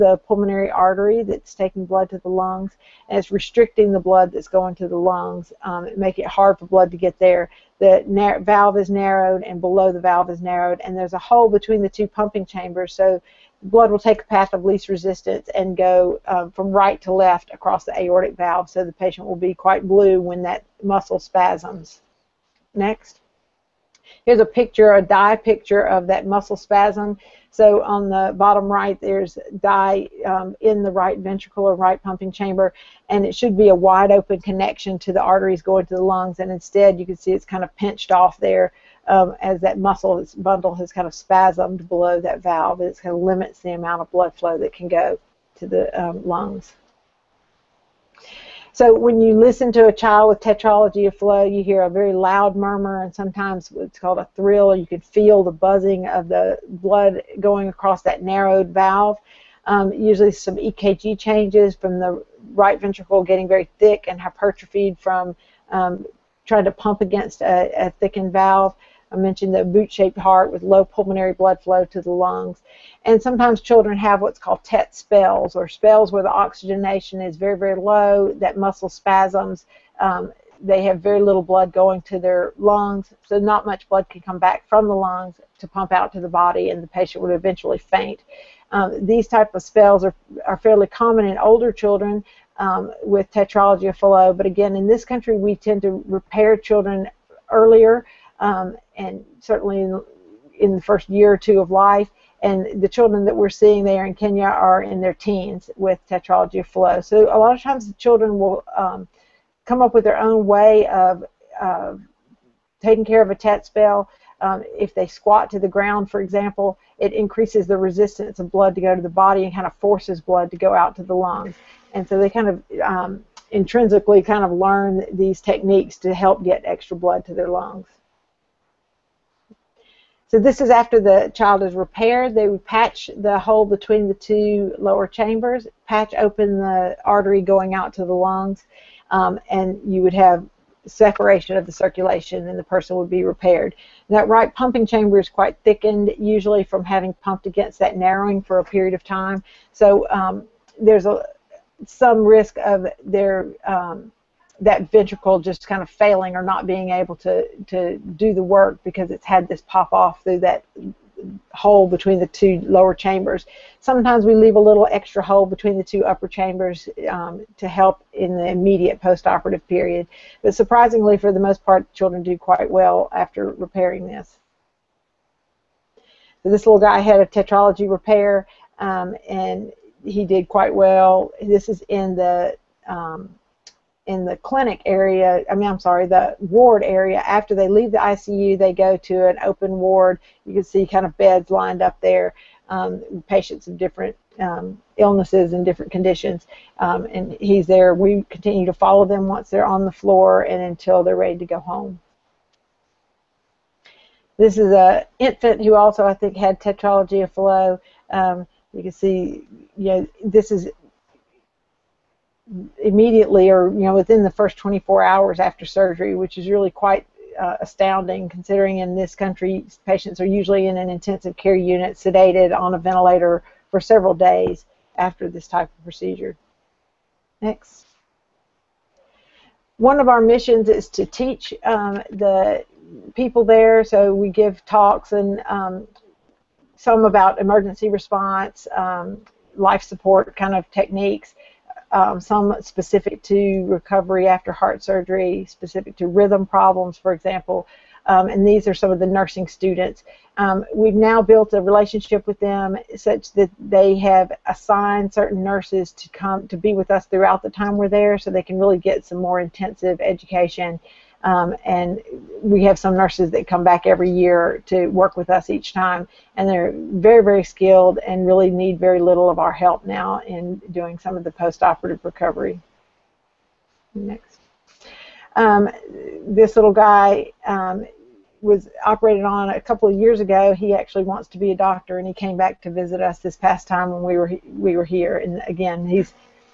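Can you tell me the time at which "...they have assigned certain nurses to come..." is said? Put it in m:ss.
4:13.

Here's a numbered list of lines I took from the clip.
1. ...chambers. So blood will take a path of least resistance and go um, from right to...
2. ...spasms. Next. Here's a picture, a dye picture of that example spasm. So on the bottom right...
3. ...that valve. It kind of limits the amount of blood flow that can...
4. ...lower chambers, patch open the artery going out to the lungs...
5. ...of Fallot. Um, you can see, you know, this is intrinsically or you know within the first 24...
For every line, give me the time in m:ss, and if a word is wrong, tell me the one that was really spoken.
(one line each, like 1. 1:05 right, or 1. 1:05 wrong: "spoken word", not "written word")
1. 0:12 right
2. 0:21 wrong: "muscle", not "example"
3. 0:42 right
4. 2:14 right
5. 3:27 wrong: "immediately", not "intrinsically".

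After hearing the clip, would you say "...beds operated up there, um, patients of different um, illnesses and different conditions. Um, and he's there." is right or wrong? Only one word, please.
wrong.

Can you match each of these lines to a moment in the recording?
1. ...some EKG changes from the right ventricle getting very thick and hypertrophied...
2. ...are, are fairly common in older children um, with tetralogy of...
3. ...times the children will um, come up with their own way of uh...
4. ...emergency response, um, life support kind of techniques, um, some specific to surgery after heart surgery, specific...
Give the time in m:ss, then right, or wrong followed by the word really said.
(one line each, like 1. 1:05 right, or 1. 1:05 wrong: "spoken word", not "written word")
1. 1:00 right
2. 1:30 right
3. 1:47 right
4. 3:57 wrong: "recovery", not "surgery".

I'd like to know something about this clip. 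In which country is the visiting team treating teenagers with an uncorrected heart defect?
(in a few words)
Kenya.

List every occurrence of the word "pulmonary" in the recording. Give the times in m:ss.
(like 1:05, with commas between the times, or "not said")
0:00, 1:10.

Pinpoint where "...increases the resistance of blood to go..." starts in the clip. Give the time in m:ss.
1:57.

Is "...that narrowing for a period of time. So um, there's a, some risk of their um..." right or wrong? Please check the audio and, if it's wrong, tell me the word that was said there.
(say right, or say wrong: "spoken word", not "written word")
right.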